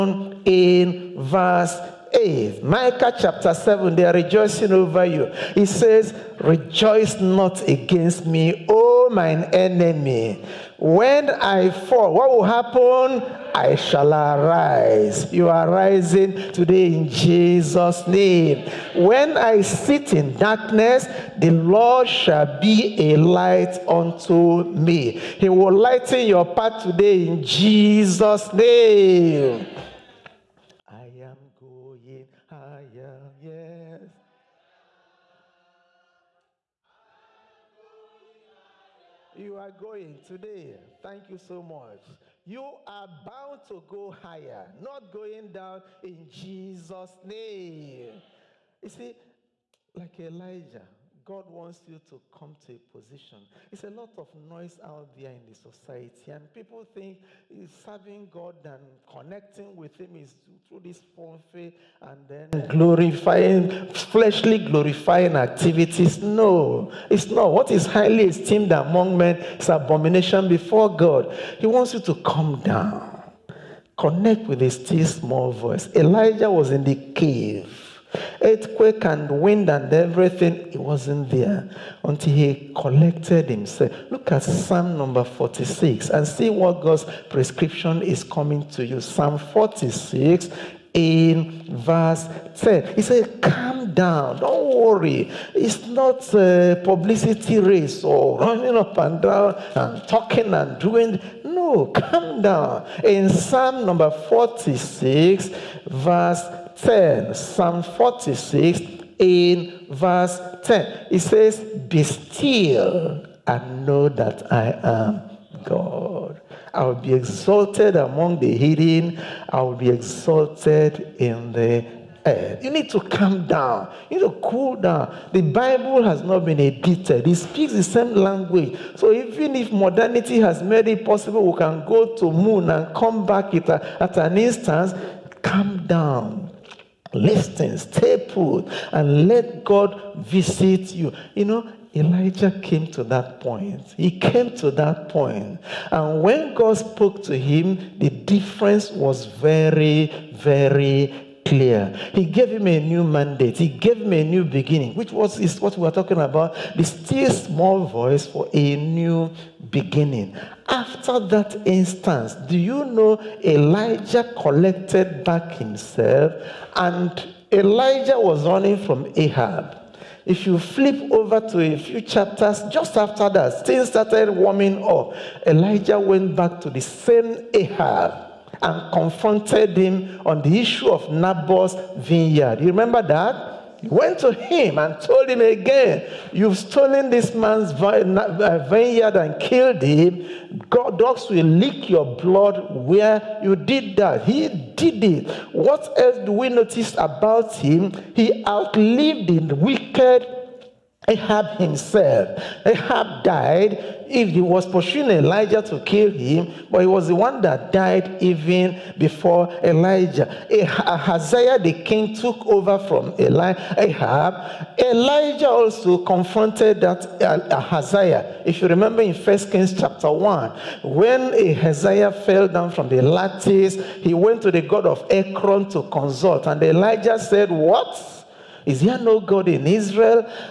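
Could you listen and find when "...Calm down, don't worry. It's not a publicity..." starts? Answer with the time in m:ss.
1:33.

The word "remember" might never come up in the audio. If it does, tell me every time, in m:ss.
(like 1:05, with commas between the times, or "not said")
3:02, 3:38.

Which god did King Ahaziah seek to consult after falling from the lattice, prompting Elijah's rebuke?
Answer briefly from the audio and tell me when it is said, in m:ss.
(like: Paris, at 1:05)
The god of Ekron, at 3:44.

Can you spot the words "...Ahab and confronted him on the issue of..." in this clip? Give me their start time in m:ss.
2:57.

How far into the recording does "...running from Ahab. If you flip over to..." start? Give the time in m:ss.
2:48.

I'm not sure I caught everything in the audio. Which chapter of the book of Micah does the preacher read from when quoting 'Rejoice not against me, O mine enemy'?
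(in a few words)
Chapter 7.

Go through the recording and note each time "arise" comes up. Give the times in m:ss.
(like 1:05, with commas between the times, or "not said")
0:14.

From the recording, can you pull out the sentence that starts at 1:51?
It says, Be still and know that I am God.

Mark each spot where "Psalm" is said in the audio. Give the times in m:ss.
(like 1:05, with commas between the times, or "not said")
1:24, 1:28, 1:43, 1:47.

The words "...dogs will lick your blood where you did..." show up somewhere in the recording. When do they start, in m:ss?
3:10.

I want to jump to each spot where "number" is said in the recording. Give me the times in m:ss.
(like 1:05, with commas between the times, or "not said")
1:24, 1:43.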